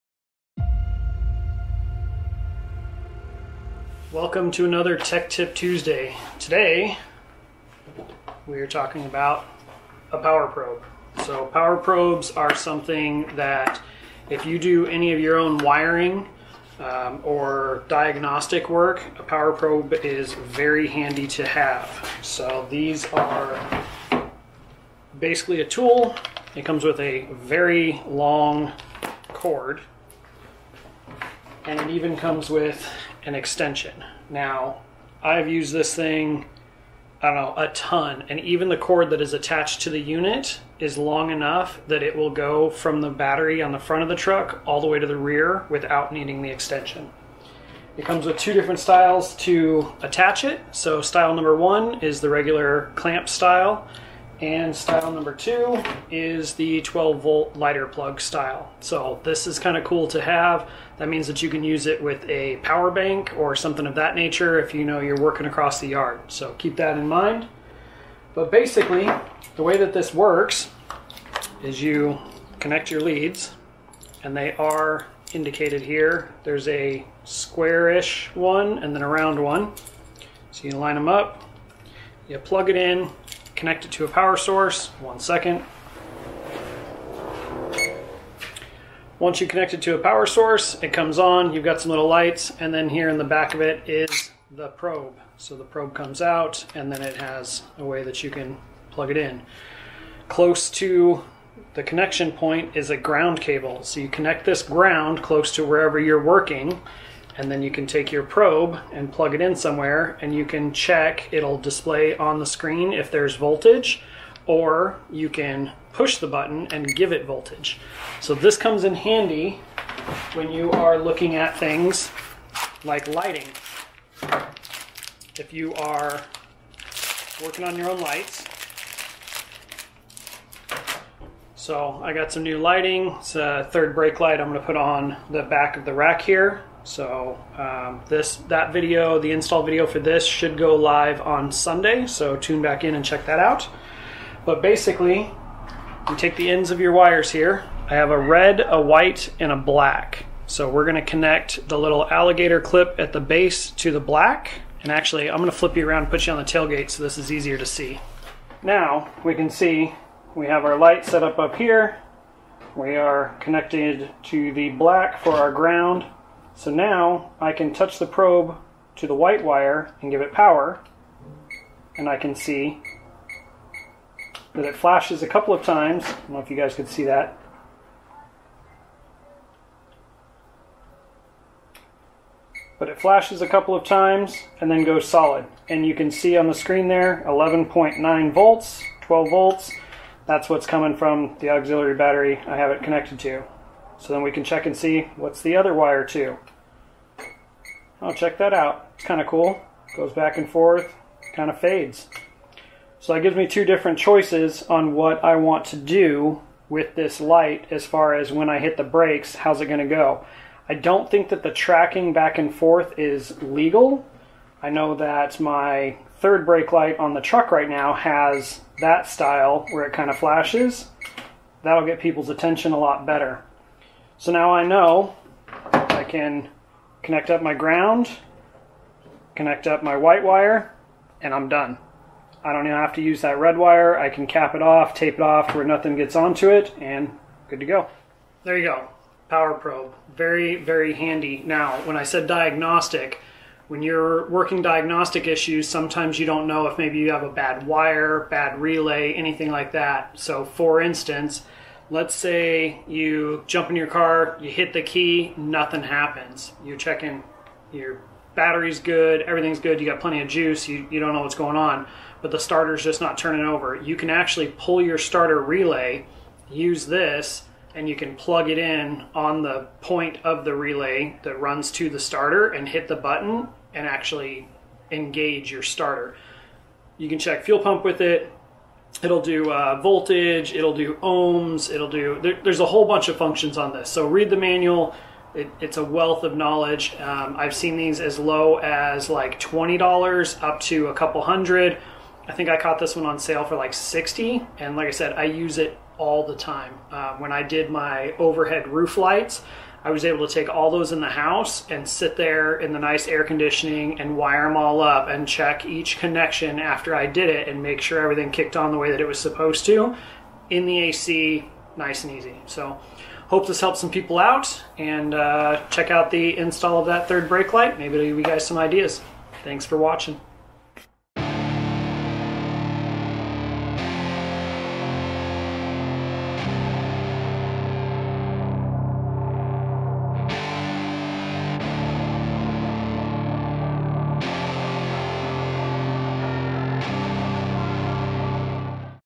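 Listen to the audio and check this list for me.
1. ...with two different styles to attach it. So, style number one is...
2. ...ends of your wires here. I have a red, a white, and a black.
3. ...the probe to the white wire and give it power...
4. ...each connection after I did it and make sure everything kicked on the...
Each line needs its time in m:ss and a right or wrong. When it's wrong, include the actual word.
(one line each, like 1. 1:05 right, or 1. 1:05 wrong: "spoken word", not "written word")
1. 0:48 right
2. 2:26 right
3. 2:47 right
4. 5:05 right.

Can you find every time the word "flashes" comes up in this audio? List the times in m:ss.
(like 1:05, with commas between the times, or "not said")
2:54, 3:02, 3:40.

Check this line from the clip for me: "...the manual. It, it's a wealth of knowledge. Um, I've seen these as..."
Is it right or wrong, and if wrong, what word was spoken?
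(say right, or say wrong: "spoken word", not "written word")
right.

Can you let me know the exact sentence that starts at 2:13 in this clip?
It's a third brake light I'm going to put on the back of the rack here.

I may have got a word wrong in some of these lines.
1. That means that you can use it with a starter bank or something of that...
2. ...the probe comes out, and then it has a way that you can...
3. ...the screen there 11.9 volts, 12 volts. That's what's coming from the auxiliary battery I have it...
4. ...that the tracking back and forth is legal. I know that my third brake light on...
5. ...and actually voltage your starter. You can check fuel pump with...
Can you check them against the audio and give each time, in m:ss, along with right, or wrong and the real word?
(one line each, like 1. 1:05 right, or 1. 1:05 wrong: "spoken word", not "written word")
1. 1:00 wrong: "power", not "starter"
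2. 1:35 right
3. 3:06 right
4. 3:31 right
5. 4:33 wrong: "engage", not "voltage".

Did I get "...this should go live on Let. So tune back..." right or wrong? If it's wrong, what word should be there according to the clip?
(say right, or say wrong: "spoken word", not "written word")
wrong: "Sunday", not "Let".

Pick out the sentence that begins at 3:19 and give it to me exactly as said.
Goes back and forth, kind of fades.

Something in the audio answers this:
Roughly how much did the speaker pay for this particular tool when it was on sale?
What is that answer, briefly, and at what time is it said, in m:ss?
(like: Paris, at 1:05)
$60, at 4:53.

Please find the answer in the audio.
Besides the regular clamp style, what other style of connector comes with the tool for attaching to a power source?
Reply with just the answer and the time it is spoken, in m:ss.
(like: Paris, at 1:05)
12 volt lighter plug, at 0:56.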